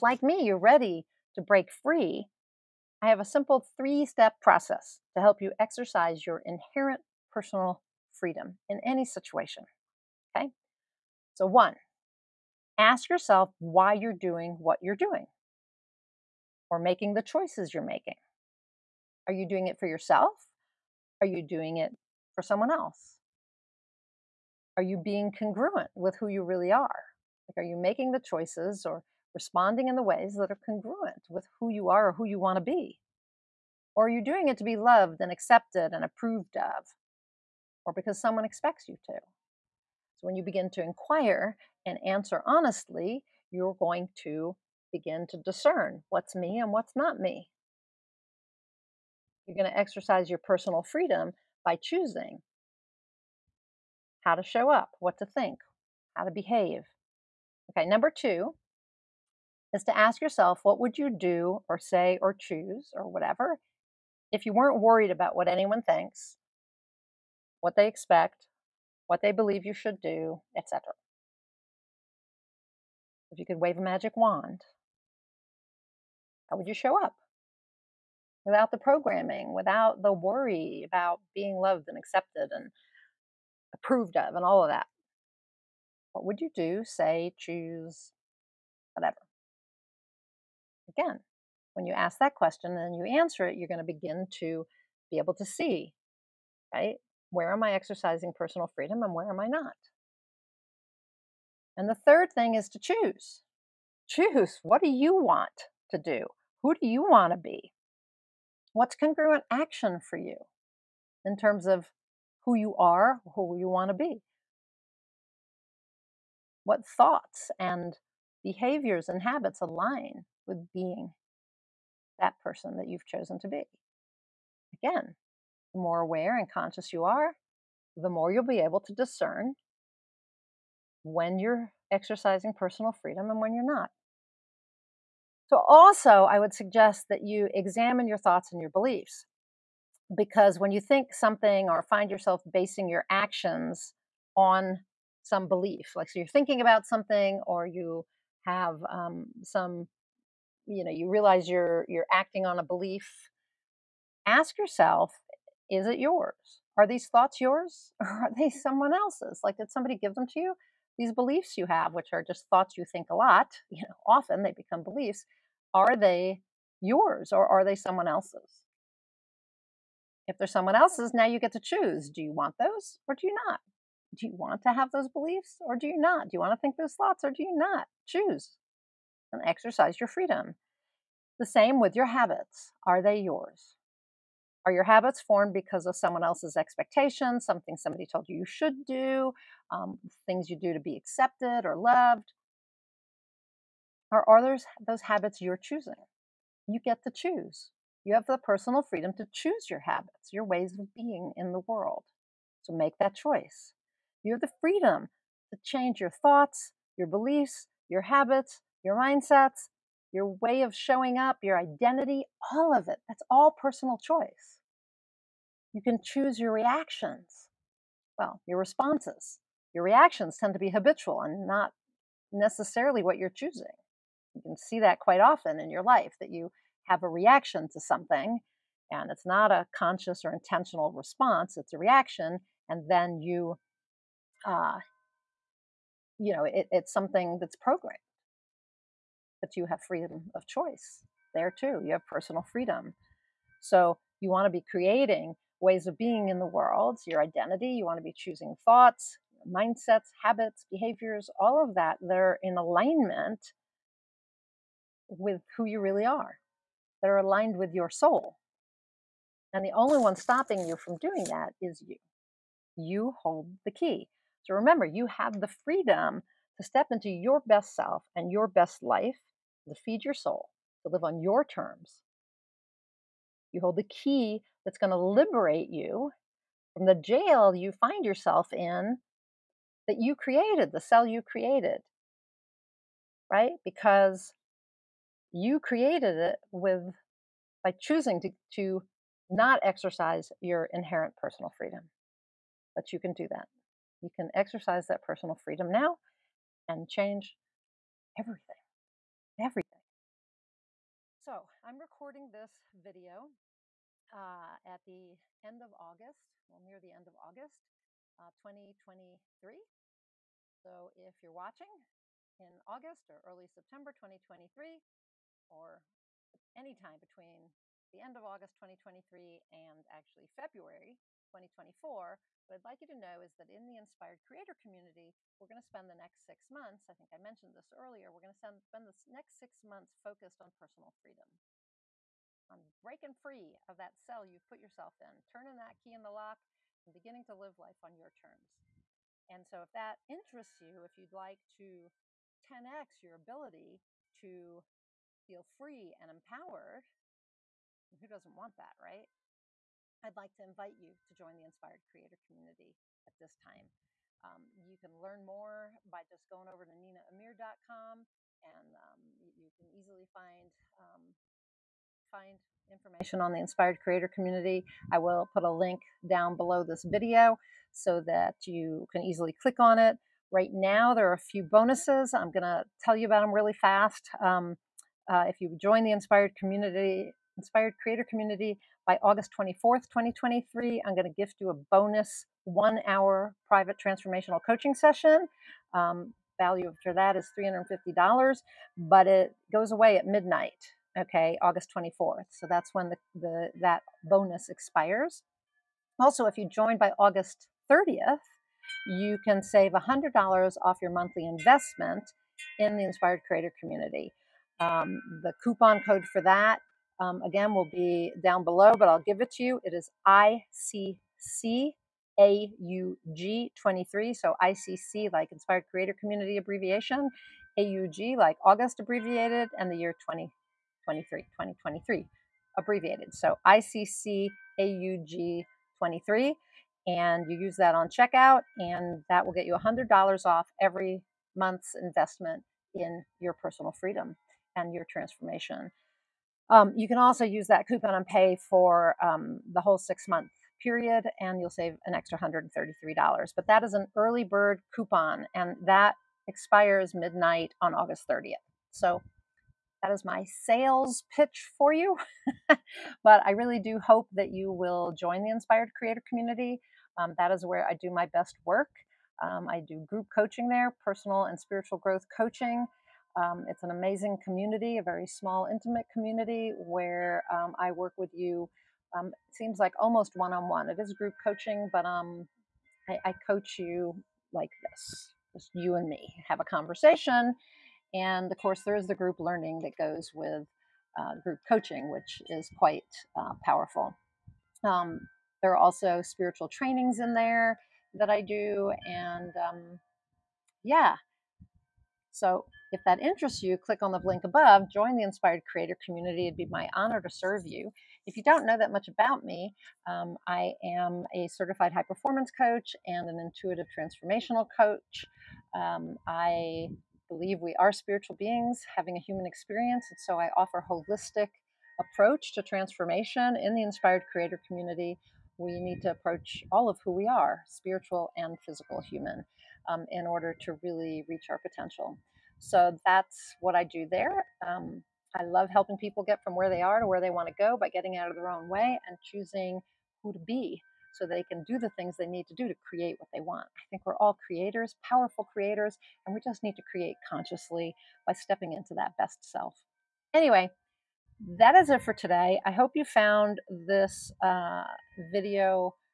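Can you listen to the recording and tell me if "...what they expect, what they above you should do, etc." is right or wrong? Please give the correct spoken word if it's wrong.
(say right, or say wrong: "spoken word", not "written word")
wrong: "believe", not "above".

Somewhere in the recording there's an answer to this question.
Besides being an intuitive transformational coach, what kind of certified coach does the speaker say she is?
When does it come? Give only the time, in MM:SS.
08:21.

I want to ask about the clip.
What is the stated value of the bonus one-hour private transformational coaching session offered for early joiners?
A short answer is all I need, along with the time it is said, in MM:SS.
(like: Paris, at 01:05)
$350, at 06:27.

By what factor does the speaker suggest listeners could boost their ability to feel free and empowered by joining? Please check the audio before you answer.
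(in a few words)
10x.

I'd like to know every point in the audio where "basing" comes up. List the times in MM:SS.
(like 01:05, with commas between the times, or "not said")
02:22.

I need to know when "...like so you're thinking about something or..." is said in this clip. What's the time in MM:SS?
02:25.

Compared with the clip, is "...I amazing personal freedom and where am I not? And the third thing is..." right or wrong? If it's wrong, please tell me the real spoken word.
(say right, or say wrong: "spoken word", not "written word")
wrong: "exercising", not "amazing".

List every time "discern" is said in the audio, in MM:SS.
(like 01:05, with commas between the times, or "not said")
00:45, 02:08.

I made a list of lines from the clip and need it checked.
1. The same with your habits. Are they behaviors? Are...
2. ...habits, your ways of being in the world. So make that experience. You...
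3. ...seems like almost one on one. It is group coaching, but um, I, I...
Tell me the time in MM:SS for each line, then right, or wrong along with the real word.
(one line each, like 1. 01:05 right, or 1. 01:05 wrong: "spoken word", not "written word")
1. 03:01 wrong: "yours", not "behaviors"
2. 03:19 wrong: "choice", not "experience"
3. 07:49 right.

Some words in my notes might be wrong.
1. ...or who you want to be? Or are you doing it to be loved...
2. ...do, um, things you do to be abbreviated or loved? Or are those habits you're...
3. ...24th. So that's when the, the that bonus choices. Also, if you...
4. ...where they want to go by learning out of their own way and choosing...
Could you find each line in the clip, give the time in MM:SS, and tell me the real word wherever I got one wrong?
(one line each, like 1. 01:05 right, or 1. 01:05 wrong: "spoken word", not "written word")
1. 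00:32 right
2. 03:08 wrong: "accepted", not "abbreviated"
3. 06:31 wrong: "expires", not "choices"
4. 08:46 wrong: "getting", not "learning".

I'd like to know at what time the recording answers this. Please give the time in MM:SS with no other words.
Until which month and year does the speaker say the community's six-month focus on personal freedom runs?
05:20.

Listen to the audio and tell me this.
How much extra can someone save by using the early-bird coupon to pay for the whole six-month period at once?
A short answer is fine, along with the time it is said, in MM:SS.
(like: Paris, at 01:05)
$133, at 07:22.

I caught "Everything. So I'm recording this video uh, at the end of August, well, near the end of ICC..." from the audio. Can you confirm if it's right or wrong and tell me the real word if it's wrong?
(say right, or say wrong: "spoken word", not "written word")
wrong: "August", not "ICC".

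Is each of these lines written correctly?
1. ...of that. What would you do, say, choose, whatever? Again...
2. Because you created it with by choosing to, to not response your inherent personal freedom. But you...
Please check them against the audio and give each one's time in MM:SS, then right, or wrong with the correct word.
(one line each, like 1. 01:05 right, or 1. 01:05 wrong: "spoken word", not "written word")
1. 01:24 right
2. 04:43 wrong: "exercise", not "response".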